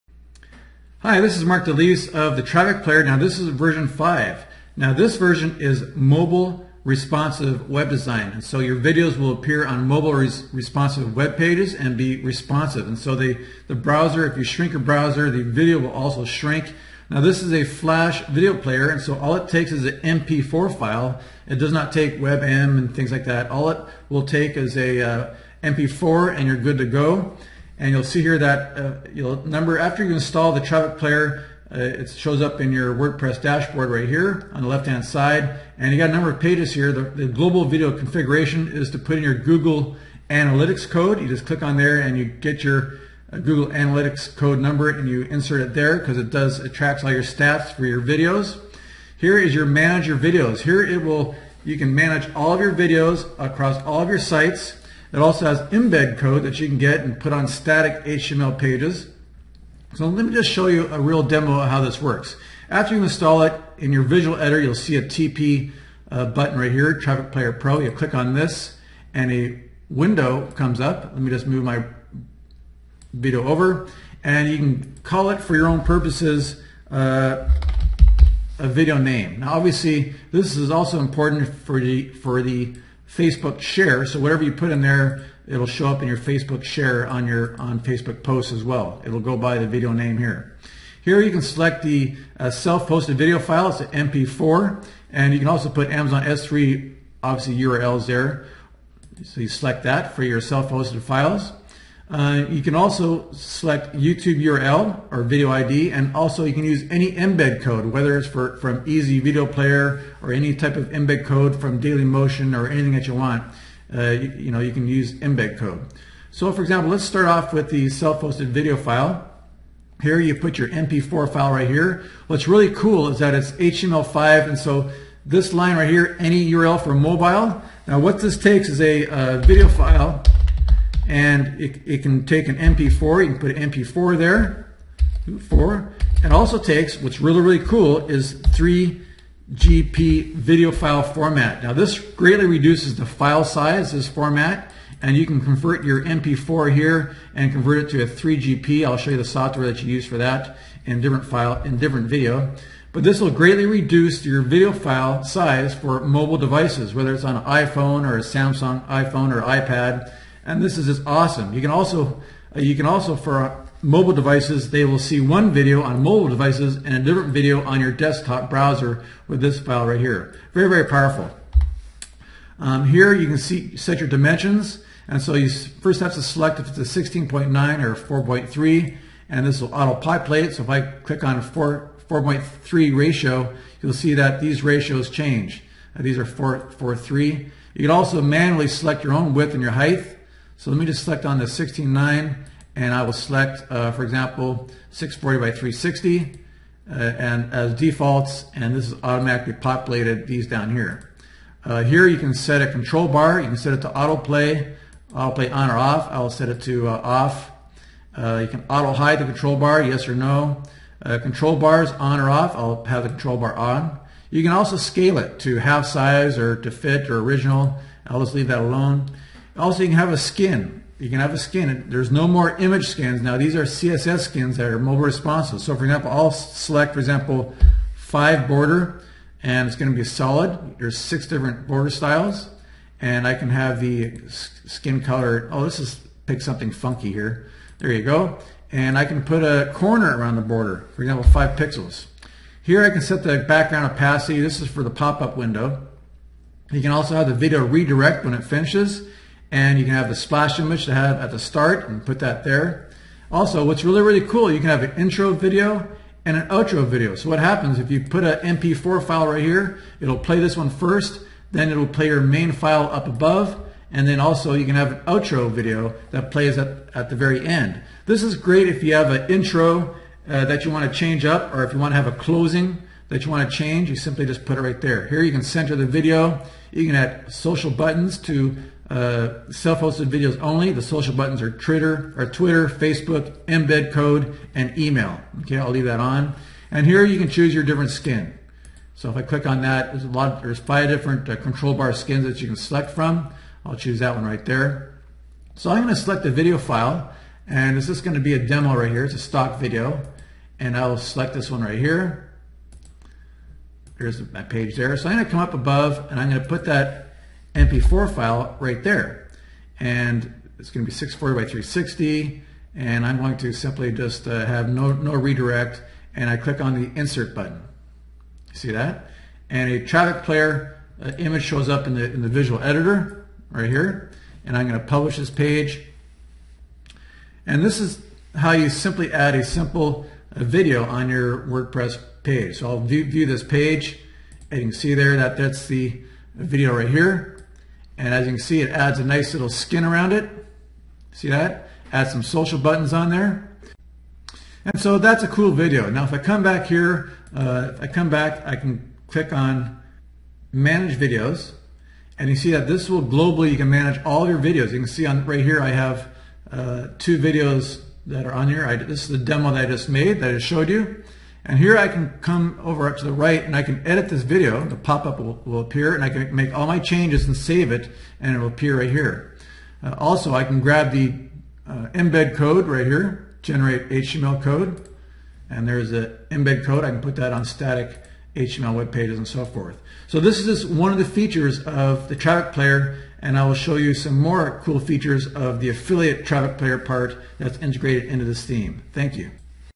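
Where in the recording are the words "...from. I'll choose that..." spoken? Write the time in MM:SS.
04:52.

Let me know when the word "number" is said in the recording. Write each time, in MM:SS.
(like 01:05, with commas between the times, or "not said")
00:29, 00:36, 00:44.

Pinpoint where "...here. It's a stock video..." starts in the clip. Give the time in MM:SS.
04:58.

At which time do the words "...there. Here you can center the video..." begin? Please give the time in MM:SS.
04:34.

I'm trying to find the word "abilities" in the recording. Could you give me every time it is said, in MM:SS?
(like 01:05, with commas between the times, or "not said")
not said.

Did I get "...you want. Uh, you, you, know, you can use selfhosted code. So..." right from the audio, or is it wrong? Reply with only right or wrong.
wrong.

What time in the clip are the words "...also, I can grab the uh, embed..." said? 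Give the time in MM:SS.
06:09.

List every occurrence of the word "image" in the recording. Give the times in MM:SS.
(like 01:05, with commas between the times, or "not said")
03:42, 04:10, 05:21.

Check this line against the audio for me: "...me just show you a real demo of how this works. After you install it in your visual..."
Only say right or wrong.
right.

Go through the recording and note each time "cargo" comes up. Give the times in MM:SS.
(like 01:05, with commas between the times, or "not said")
not said.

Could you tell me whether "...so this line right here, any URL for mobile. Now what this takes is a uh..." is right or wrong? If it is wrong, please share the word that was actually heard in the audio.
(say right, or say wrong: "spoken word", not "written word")
right.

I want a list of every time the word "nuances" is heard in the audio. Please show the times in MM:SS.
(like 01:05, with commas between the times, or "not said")
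not said.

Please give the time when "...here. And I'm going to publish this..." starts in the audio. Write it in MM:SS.
05:23.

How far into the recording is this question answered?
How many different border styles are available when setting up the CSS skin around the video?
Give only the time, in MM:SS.
03:50.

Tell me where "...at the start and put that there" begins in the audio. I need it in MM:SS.
04:11.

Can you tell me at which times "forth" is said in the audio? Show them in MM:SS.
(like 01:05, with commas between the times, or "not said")
06:19.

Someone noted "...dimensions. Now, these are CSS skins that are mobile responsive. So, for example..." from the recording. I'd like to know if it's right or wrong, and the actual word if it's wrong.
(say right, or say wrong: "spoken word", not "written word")
wrong: "skins", not "dimensions".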